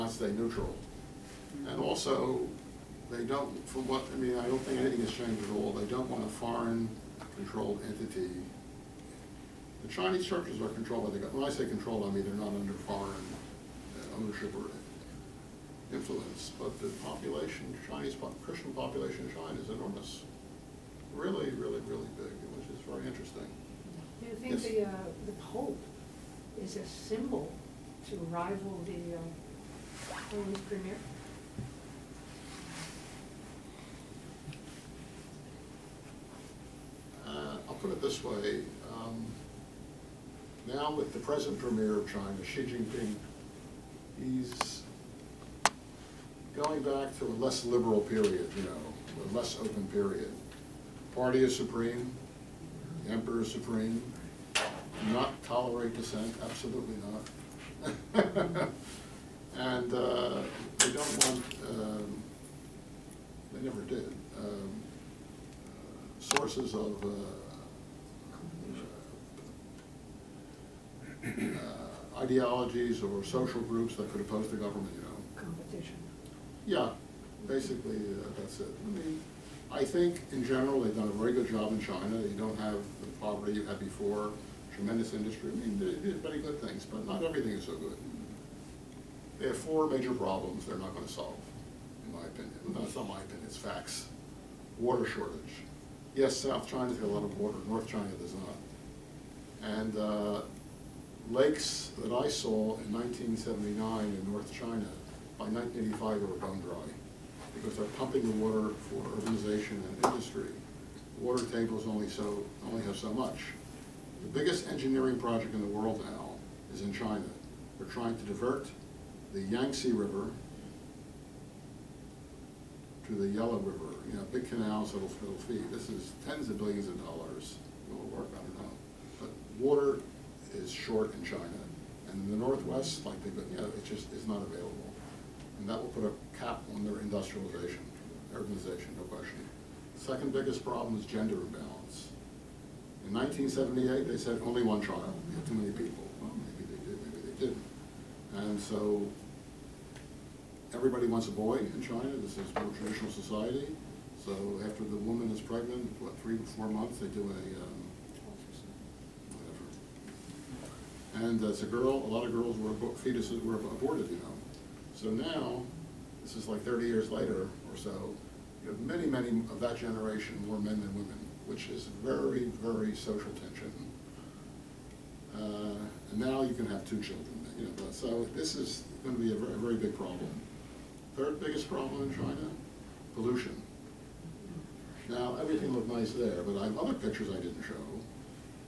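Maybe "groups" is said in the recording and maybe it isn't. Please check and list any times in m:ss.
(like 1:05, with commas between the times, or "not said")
1:13.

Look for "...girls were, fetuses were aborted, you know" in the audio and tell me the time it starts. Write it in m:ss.
2:42.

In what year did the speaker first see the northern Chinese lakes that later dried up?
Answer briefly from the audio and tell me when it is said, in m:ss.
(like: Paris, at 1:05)
1979, at 1:42.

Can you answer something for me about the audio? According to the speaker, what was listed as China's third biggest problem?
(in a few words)
Pollution.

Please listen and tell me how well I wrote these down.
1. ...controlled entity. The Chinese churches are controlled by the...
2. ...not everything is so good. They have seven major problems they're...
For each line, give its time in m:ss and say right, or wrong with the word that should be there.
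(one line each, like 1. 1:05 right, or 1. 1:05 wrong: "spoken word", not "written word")
1. 0:07 right
2. 1:27 wrong: "four", not "seven".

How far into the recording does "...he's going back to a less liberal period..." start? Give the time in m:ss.
0:44.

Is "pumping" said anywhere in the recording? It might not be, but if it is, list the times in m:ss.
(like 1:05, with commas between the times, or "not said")
1:48.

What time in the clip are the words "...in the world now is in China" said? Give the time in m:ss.
1:55.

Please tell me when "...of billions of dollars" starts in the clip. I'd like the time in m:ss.
2:06.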